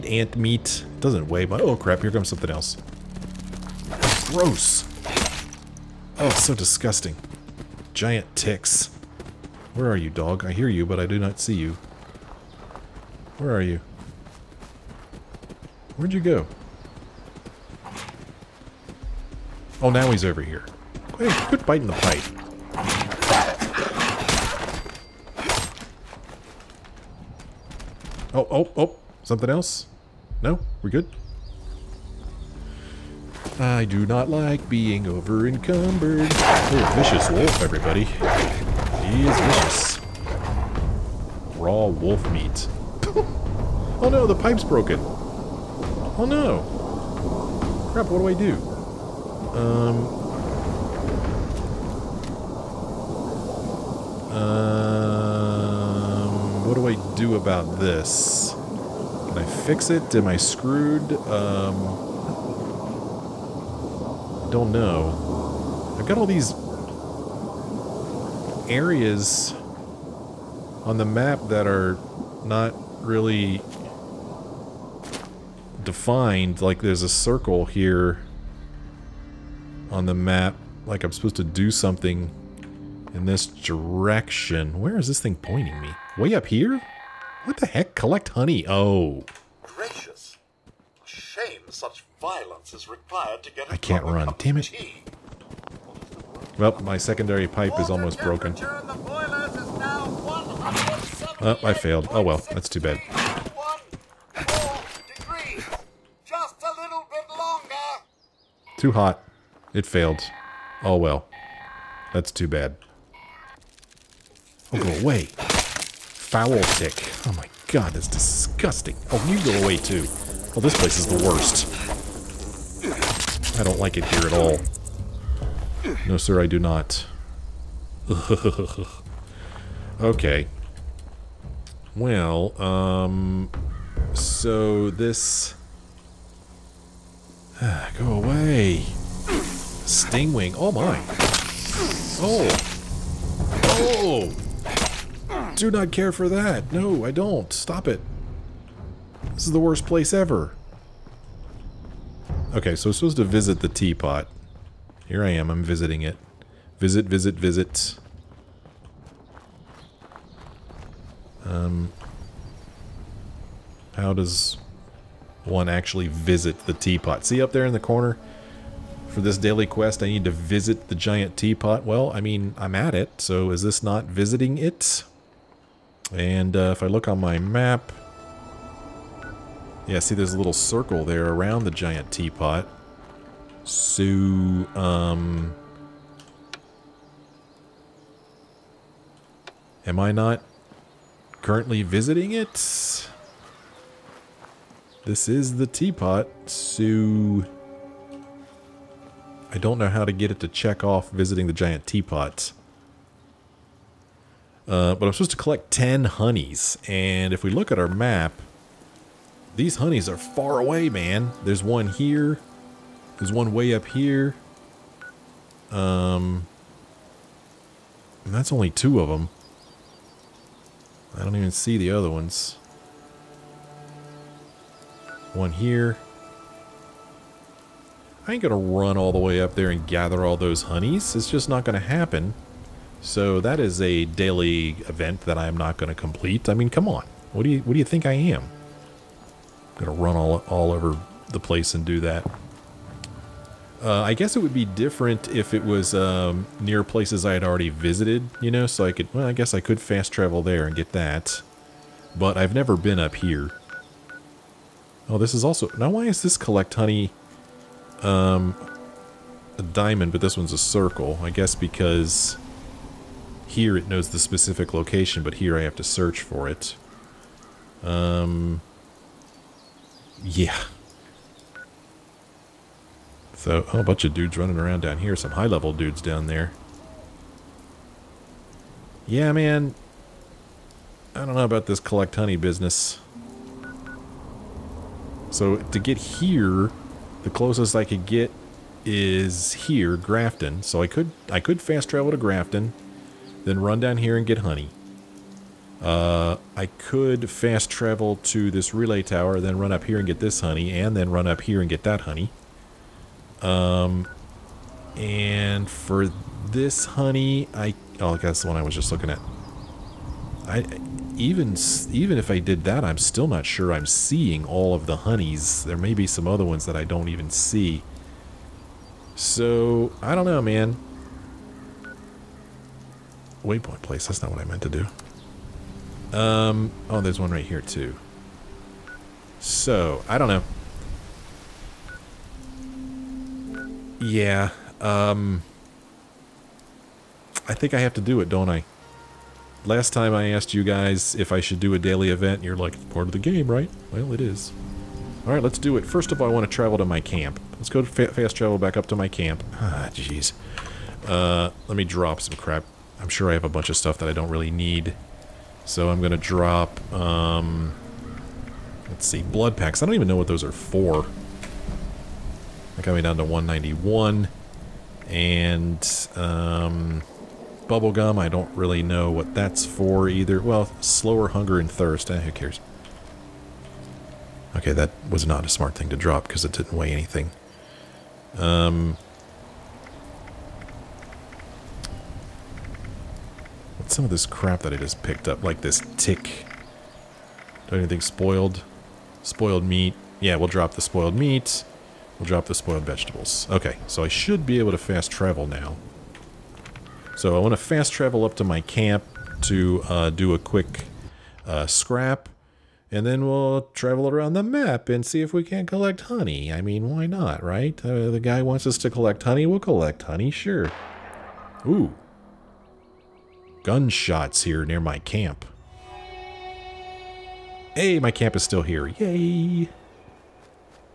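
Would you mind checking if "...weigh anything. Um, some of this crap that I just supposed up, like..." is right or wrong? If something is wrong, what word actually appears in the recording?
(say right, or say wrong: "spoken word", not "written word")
wrong: "picked", not "supposed".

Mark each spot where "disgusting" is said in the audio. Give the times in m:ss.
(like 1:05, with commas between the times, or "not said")
0:06, 1:58.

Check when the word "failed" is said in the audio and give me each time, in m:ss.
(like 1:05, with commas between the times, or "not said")
1:41, 1:49.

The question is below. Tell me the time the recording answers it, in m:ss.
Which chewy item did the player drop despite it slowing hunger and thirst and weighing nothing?
6:07.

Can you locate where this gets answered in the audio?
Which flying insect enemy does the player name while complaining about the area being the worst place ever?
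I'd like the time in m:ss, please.
2:19.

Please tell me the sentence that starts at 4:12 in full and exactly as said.
But I've never been up here.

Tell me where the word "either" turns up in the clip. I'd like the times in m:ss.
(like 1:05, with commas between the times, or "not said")
6:10.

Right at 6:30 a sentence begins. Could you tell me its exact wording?
Yeah, we'll drop the spoiled meat.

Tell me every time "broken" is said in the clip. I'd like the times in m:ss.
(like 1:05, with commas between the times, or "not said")
0:44, 1:38.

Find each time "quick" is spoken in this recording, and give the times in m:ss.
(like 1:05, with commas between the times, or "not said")
6:40.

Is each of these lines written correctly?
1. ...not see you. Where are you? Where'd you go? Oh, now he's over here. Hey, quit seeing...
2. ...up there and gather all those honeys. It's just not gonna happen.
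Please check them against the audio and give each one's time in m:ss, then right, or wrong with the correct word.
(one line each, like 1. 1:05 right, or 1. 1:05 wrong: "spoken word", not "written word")
1. 0:11 wrong: "biting", not "seeing"
2. 3:49 right.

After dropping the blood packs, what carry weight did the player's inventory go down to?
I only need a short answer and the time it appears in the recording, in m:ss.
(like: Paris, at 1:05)
191, at 6:03.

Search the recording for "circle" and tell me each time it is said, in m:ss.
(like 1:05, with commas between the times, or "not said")
1:17, 3:00, 4:20.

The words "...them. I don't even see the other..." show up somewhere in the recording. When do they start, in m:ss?
3:39.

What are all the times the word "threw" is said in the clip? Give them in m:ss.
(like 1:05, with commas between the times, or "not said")
not said.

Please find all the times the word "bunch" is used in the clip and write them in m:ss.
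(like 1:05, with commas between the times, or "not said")
4:33, 5:53.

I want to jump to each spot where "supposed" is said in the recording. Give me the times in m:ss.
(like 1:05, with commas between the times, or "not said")
1:21, 2:32, 3:25.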